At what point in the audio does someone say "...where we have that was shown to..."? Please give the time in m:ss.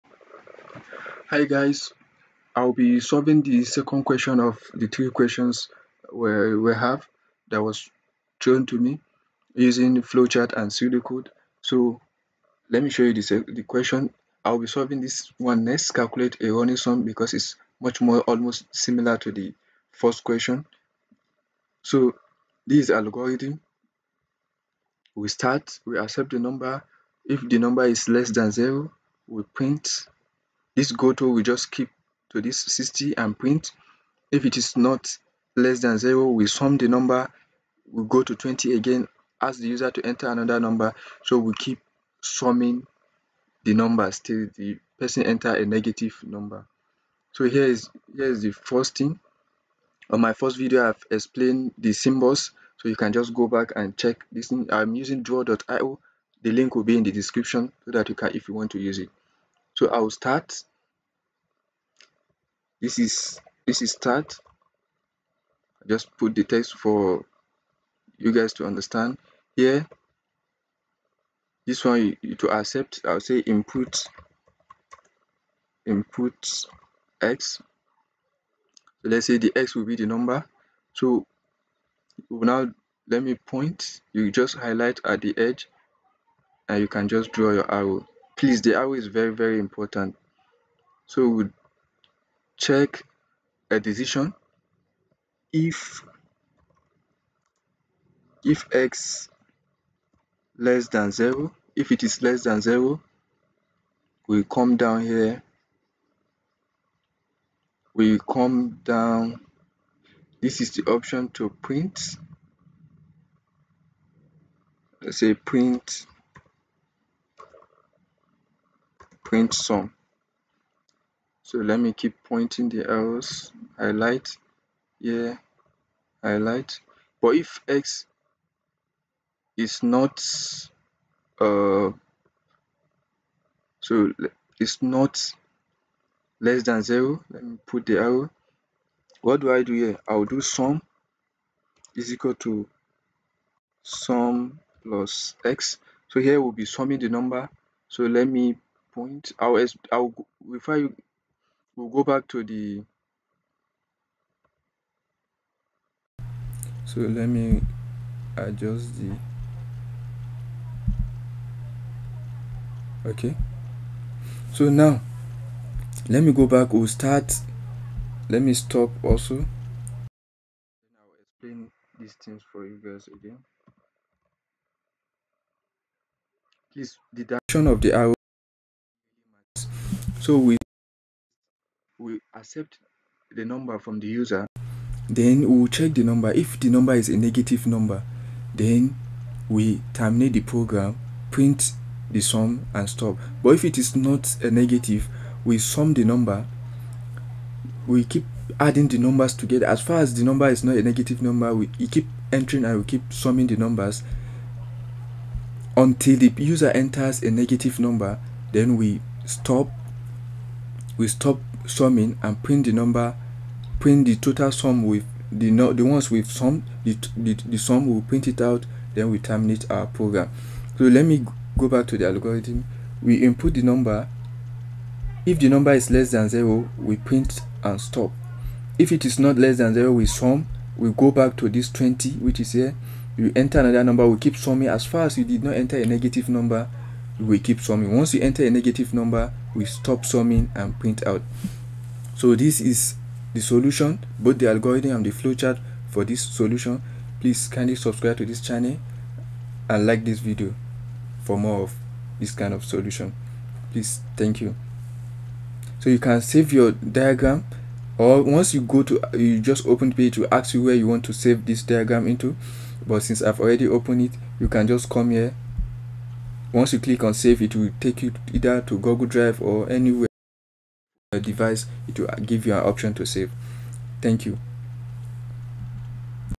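0:06.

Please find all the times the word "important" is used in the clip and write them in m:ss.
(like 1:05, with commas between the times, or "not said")
1:29.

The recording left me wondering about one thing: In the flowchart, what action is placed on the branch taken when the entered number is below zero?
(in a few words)
print sum.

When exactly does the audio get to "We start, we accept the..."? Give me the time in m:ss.
0:25.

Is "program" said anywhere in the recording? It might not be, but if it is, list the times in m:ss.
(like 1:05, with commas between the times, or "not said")
3:10, 3:39.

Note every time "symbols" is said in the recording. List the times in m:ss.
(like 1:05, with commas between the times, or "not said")
0:51.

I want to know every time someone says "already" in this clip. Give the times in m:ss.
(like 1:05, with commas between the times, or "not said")
4:23.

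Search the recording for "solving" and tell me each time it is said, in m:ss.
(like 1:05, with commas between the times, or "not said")
0:02, 0:14.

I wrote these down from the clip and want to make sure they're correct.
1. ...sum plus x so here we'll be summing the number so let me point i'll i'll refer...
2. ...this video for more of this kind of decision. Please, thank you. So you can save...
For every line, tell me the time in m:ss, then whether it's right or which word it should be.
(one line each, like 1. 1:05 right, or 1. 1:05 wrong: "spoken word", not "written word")
1. 2:23 right
2. 4:10 wrong: "solution", not "decision".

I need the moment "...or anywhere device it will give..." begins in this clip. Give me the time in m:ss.
4:29.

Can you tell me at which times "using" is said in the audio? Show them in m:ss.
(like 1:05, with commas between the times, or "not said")
0:09, 0:54.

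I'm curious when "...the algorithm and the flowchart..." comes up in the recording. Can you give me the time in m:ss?
4:04.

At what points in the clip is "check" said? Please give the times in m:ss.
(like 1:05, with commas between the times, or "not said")
0:53, 1:32, 3:05.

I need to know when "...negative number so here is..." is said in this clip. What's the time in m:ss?
0:45.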